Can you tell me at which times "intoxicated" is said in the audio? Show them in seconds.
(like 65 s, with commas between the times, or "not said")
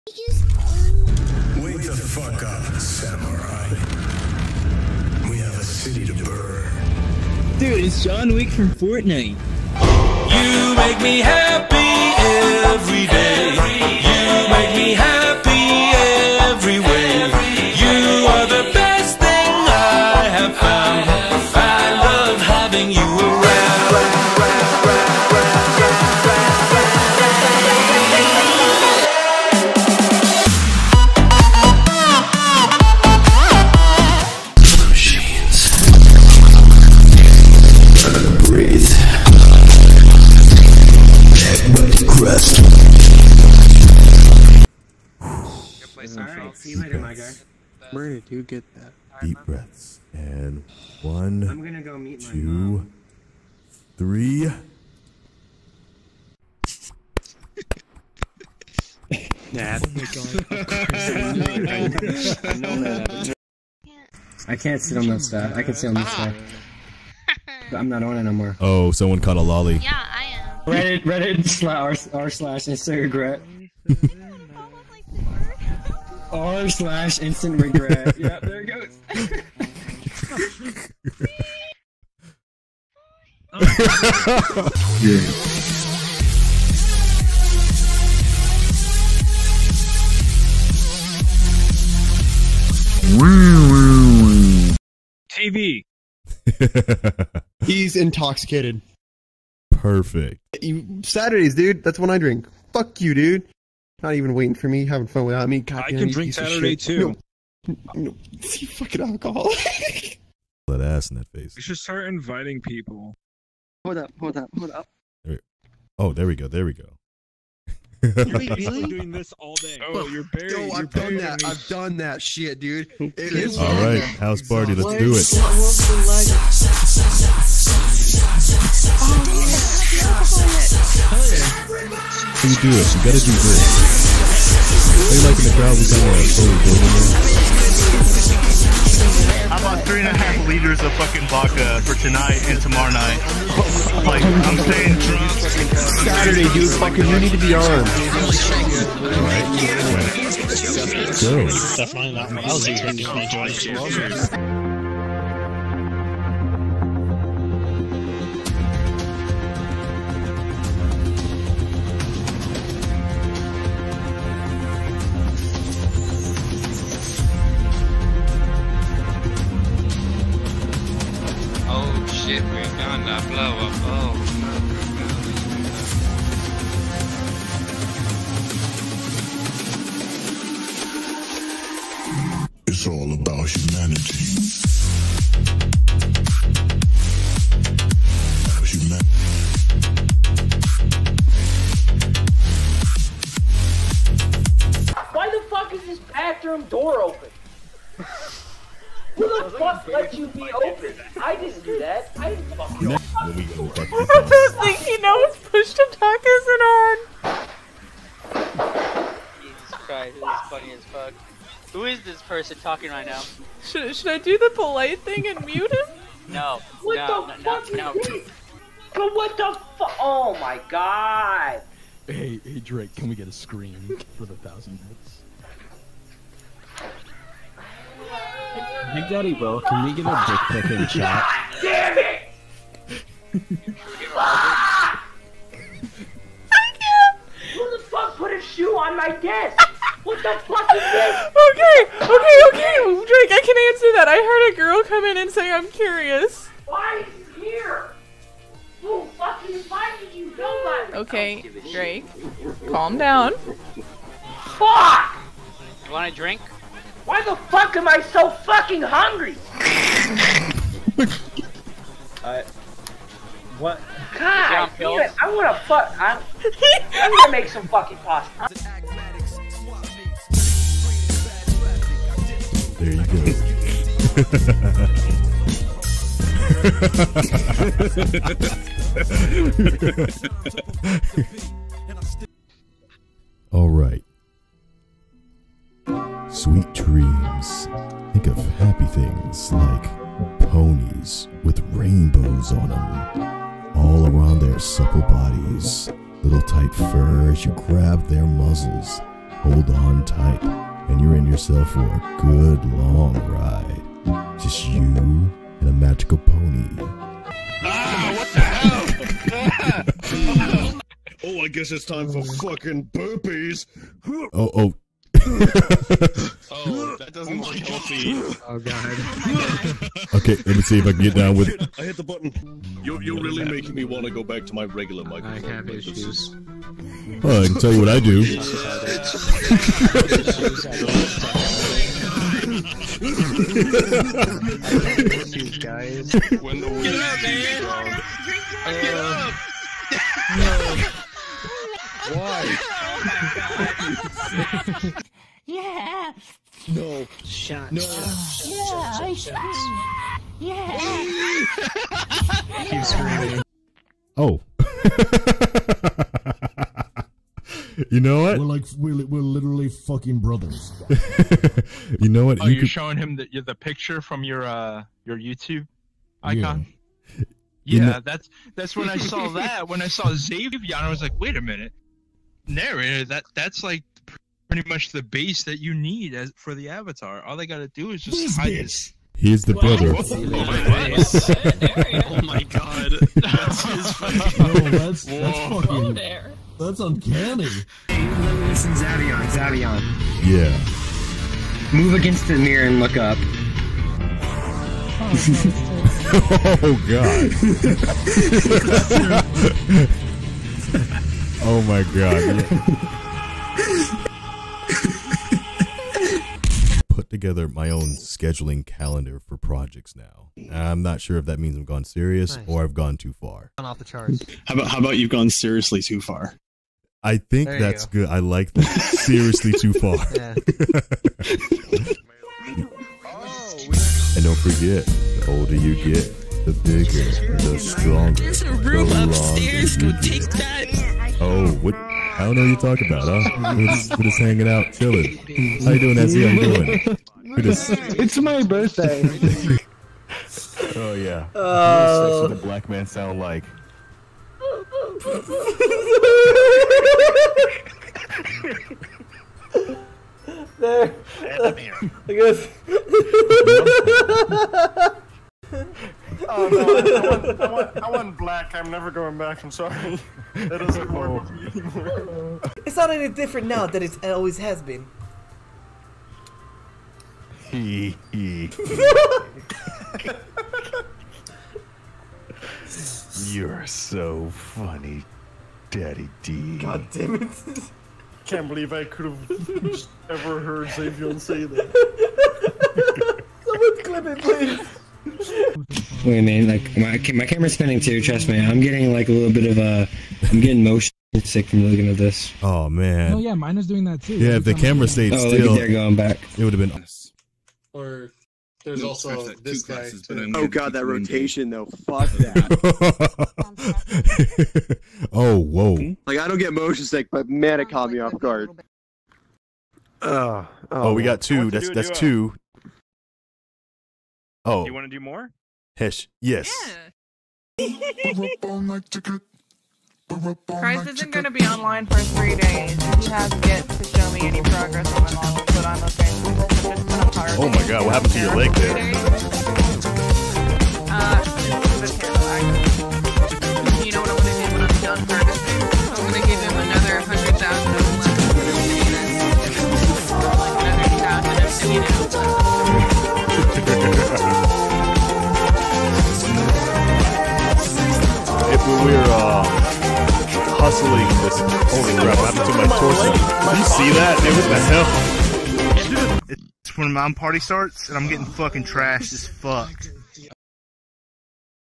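97 s.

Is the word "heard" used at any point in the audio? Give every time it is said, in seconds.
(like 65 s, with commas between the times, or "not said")
244 s, 480 s.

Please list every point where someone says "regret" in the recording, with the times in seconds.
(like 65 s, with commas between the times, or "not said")
73 s, 77 s.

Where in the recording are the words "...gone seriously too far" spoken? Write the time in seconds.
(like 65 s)
415 s.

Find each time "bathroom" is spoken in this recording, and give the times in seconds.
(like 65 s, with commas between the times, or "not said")
196 s.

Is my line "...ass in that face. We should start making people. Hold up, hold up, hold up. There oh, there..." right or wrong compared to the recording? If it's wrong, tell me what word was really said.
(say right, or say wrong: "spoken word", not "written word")
wrong: "inviting", not "making".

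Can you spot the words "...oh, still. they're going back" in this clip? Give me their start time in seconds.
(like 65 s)
495 s.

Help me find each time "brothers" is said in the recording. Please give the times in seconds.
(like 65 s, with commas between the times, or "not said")
360 s, 379 s.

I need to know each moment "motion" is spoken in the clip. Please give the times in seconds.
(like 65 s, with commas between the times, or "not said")
490 s, 506 s.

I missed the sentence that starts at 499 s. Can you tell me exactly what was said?
Classes, oh god, that rotation though.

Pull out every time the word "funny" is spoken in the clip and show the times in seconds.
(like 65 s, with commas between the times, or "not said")
210 s, 474 s.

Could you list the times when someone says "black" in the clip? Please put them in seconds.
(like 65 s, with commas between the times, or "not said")
442 s, 458 s.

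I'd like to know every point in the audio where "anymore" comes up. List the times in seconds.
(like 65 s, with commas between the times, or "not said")
68 s, 461 s.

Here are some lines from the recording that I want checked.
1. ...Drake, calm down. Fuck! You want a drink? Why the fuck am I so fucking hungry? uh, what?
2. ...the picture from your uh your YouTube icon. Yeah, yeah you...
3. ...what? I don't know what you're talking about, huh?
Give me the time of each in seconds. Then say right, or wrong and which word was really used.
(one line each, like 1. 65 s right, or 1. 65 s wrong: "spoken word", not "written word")
1. 251 s right
2. 363 s right
3. 431 s right.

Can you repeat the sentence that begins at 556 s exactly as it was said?
when my party starts and I'm getting fucking trashed as fucked.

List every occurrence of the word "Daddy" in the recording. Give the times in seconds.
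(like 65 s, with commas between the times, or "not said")
229 s, 475 s.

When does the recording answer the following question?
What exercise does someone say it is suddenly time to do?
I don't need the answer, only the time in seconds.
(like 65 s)
312 s.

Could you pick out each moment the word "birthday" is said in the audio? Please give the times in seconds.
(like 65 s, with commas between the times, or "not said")
438 s.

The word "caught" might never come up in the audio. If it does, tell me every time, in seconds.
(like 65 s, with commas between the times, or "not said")
69 s, 507 s.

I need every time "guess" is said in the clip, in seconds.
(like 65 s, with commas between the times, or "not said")
311 s, 452 s.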